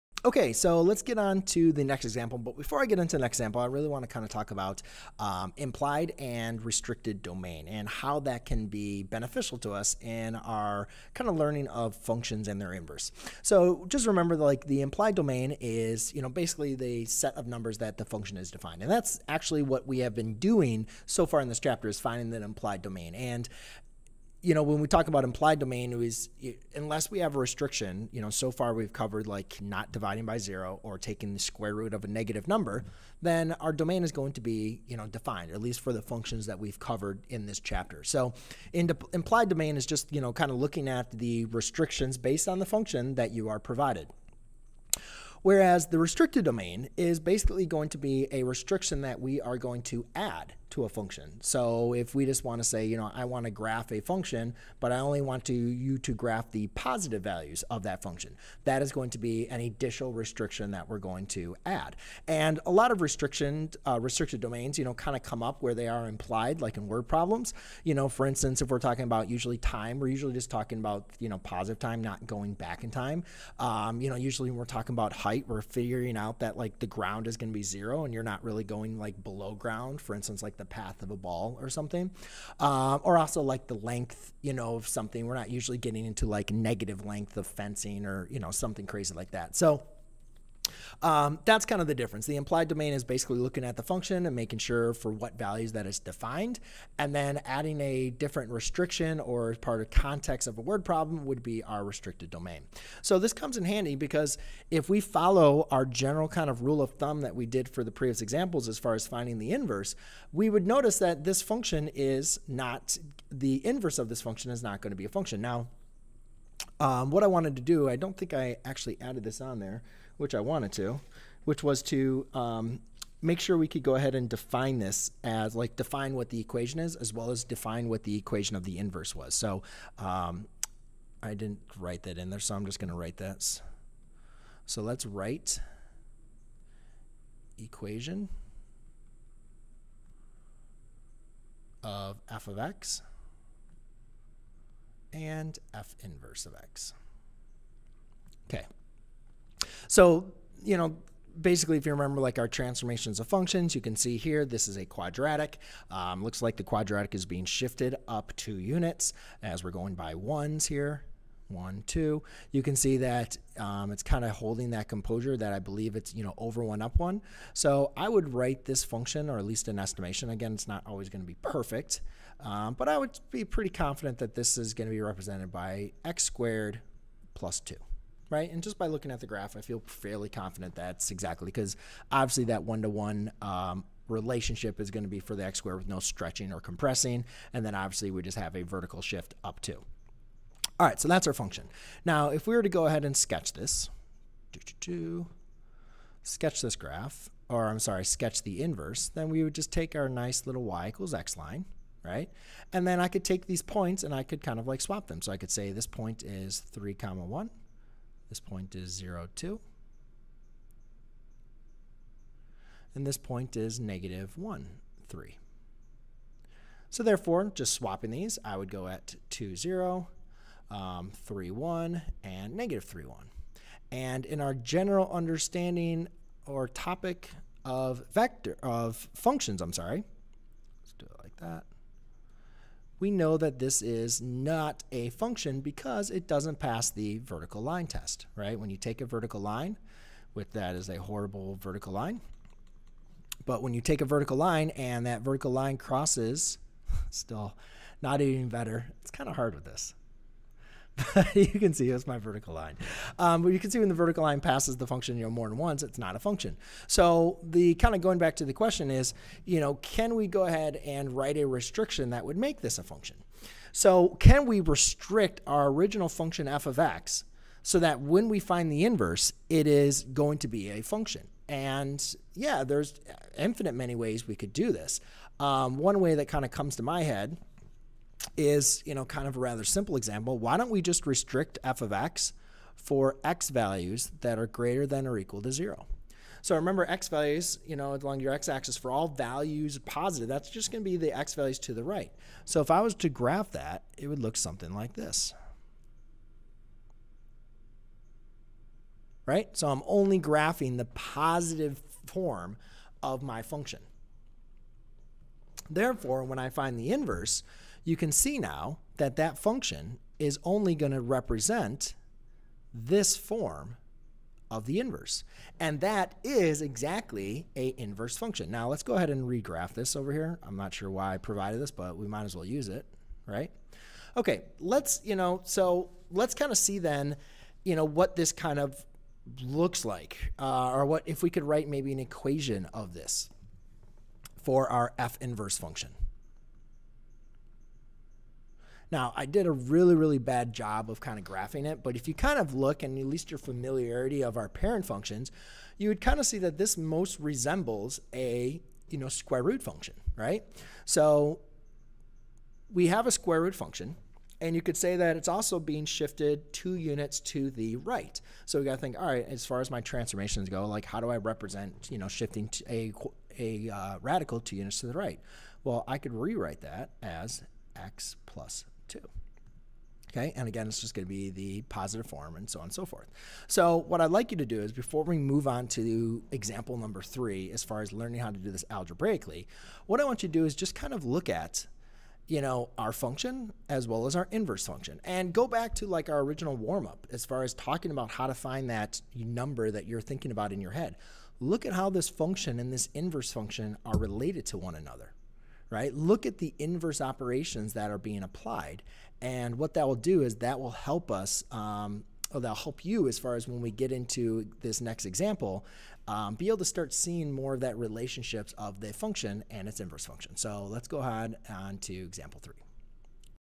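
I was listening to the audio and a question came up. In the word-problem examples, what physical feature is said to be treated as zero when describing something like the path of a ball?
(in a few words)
the ground.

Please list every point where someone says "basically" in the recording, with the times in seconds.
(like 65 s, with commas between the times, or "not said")
16 s, 47 s, 93 s, 151 s.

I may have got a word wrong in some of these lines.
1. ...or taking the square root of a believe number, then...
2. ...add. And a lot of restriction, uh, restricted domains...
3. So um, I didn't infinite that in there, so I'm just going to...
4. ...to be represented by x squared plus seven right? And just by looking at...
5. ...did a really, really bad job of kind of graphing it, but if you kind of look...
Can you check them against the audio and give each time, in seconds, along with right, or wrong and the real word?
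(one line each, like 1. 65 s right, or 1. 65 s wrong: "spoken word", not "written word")
1. 30 s wrong: "negative", not "believe"
2. 61 s right
3. 129 s wrong: "write", not "infinite"
4. 174 s wrong: "two", not "seven"
5. 339 s right.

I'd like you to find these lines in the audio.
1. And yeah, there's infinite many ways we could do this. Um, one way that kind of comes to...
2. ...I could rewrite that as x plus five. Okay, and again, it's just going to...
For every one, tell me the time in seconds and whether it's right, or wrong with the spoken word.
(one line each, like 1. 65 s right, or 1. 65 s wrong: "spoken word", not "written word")
1. 271 s right
2. 365 s wrong: "two", not "five".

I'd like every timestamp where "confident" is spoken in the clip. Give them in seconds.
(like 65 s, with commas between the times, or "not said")
173 s, 180 s.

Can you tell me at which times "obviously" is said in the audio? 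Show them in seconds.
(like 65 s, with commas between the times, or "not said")
182 s, 187 s.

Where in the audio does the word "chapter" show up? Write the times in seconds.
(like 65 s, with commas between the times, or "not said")
21 s, 37 s.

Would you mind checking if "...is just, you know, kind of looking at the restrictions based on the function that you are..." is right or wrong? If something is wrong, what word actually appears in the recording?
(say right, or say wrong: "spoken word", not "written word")
right.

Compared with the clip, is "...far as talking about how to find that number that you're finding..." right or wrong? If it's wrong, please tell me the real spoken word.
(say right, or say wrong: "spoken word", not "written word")
wrong: "thinking", not "finding".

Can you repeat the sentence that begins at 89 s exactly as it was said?
So um, that's kind of the difference.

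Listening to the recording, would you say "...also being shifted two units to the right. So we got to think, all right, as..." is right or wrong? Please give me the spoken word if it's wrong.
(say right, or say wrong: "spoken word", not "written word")
right.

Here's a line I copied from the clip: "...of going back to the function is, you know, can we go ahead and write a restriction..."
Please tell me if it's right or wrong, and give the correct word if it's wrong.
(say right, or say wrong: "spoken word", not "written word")
wrong: "question", not "function".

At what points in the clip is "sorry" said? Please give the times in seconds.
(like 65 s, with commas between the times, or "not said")
197 s, 229 s.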